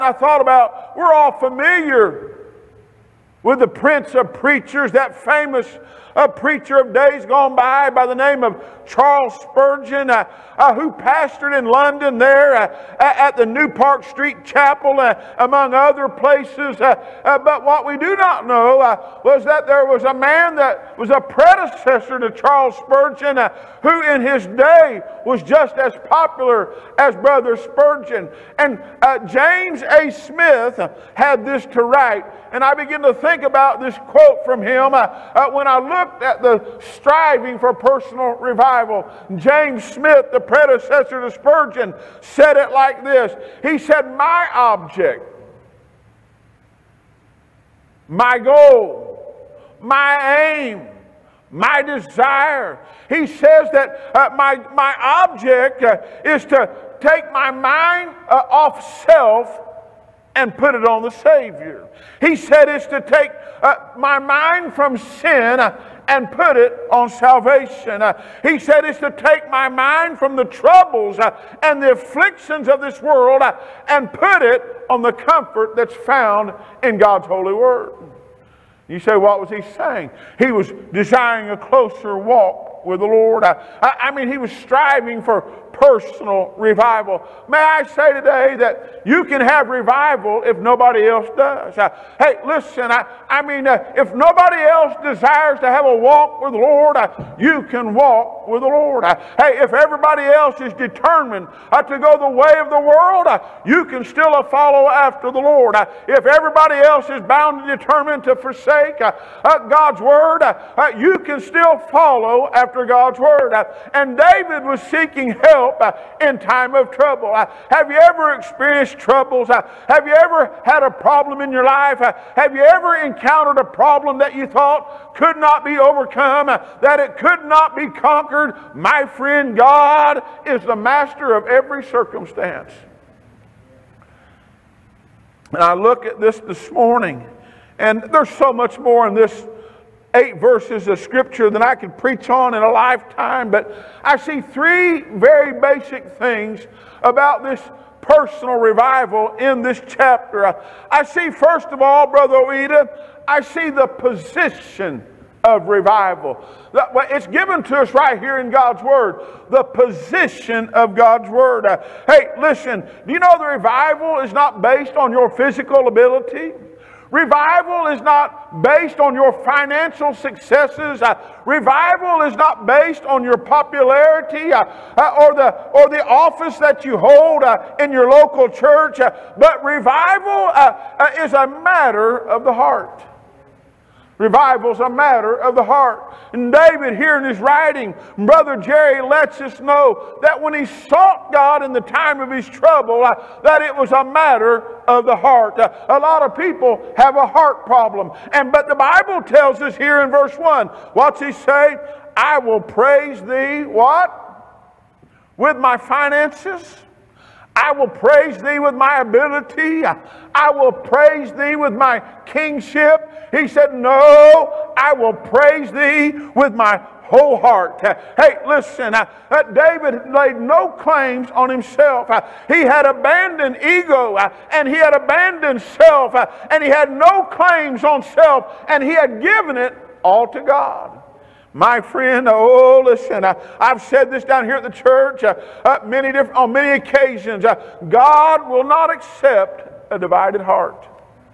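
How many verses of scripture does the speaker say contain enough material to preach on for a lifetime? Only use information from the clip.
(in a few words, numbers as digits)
8.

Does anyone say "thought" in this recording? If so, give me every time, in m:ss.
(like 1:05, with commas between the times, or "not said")
0:00, 2:04.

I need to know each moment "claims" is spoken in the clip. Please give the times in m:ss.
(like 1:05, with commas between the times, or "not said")
3:40, 3:47.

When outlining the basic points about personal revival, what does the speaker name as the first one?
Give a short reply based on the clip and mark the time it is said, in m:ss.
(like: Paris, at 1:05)
The position of revival, at 2:33.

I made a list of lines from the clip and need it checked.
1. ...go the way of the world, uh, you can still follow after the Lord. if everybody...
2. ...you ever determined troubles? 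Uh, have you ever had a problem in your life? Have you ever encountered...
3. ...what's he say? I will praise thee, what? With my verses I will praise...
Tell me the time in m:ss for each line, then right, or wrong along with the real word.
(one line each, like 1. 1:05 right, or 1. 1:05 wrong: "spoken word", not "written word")
1. 1:41 right
2. 1:57 wrong: "experienced", not "determined"
3. 3:20 wrong: "finances", not "verses".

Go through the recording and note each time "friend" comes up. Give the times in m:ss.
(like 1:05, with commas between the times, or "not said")
2:09, 3:51.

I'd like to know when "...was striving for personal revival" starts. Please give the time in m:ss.
1:24.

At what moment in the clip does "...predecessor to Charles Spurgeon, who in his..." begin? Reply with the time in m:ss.
0:21.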